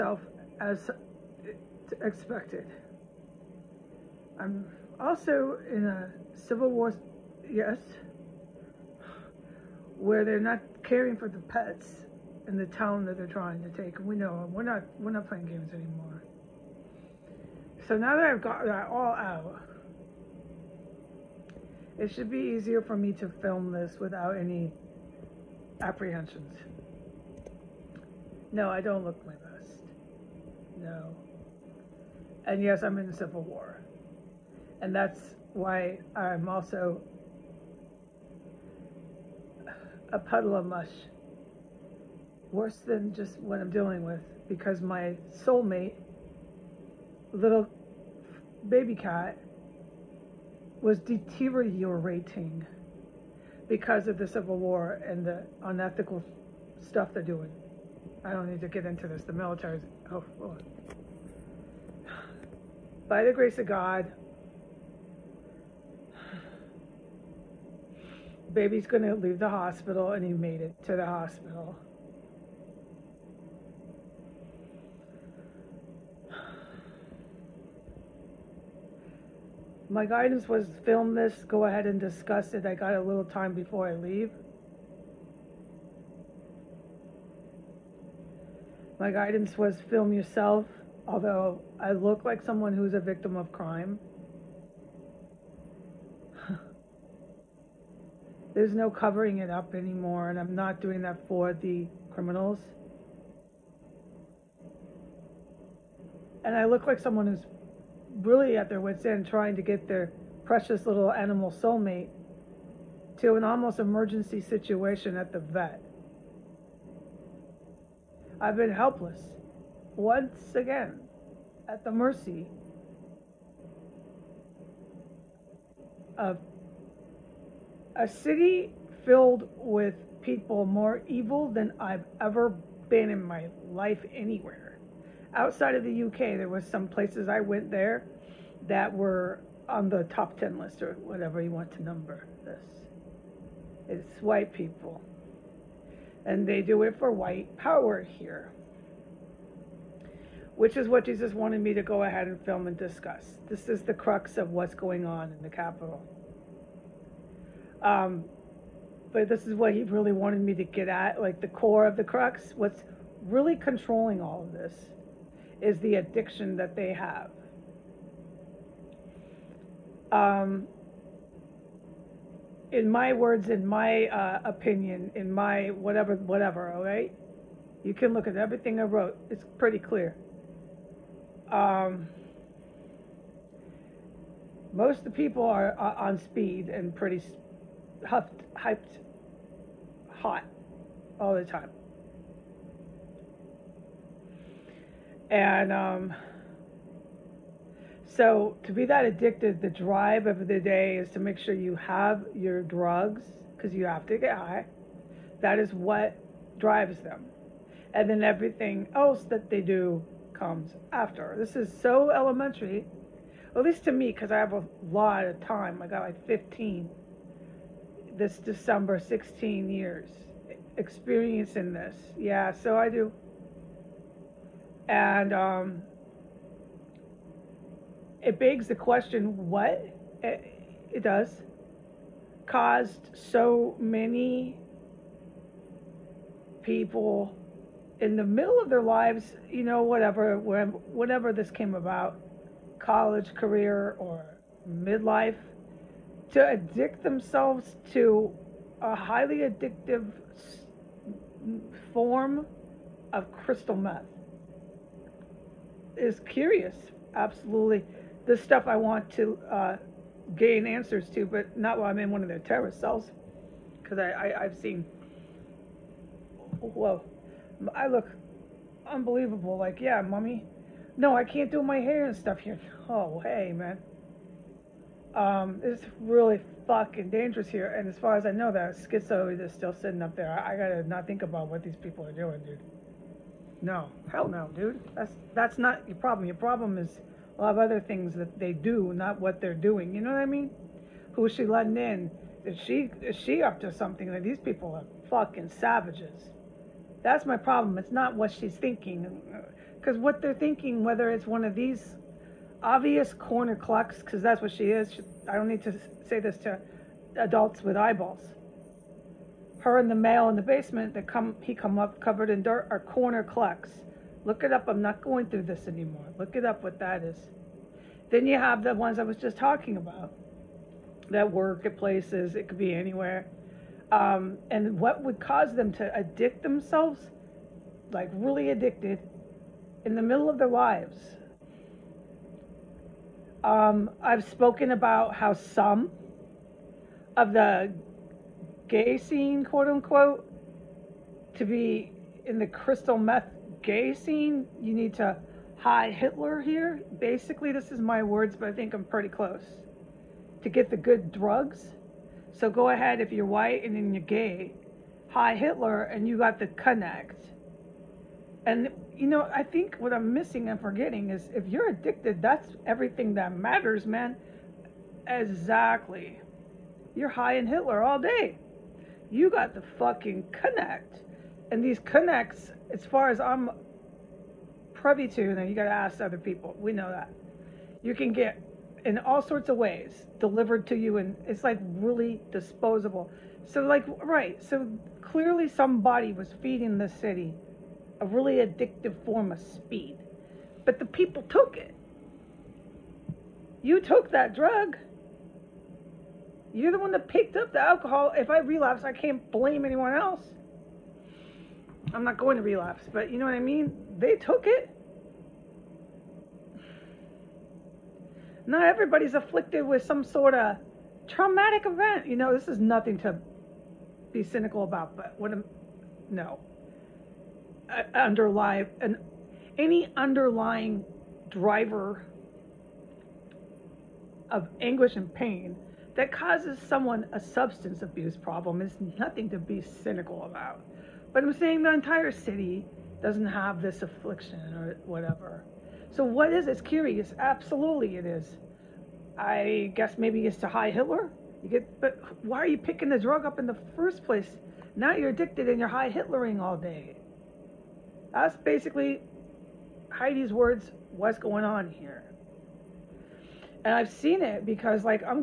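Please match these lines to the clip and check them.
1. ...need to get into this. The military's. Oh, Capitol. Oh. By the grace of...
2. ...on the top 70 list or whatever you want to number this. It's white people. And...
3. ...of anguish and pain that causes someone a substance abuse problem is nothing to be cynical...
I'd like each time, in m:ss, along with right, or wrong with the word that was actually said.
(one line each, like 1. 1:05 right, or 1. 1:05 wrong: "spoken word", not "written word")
1. 0:58 wrong: "Lord", not "Capitol"
2. 2:19 wrong: "10", not "70"
3. 7:04 right.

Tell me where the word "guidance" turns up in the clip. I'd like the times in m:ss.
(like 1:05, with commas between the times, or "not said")
1:20, 1:29.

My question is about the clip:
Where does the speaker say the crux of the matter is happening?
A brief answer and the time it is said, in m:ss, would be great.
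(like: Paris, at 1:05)
the Capitol, at 2:35.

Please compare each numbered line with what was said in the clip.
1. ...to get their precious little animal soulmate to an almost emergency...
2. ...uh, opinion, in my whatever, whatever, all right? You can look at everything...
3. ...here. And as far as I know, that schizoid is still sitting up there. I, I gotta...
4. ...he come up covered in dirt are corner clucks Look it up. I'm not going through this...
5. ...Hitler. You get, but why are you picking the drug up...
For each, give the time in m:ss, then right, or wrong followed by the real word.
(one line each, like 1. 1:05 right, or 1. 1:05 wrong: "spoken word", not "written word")
1. 1:49 right
2. 2:54 right
3. 4:37 right
4. 5:11 right
5. 7:20 right.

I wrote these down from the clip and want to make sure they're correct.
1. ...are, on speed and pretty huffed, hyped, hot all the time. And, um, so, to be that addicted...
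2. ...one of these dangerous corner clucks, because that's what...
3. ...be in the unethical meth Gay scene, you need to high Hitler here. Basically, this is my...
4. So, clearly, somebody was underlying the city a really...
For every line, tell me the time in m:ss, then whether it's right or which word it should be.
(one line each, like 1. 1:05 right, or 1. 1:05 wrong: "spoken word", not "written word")
1. 3:05 right
2. 5:01 wrong: "obvious", not "dangerous"
3. 5:41 wrong: "crystal", not "unethical"
4. 6:24 wrong: "feeding", not "underlying".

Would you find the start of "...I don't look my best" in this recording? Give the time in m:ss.
0:28.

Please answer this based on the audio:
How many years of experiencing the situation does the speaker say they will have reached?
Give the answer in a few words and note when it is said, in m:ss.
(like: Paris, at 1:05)
16 years, at 3:38.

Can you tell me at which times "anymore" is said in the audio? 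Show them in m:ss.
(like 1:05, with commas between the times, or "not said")
0:15, 1:39, 5:15.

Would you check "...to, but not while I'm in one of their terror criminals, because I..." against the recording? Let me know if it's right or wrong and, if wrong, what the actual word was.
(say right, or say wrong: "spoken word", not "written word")
wrong: "cells", not "criminals".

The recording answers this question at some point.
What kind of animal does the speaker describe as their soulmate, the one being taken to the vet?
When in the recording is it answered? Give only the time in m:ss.
0:48.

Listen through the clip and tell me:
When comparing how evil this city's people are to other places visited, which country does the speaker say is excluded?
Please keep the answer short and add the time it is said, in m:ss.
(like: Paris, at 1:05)
UK, at 2:16.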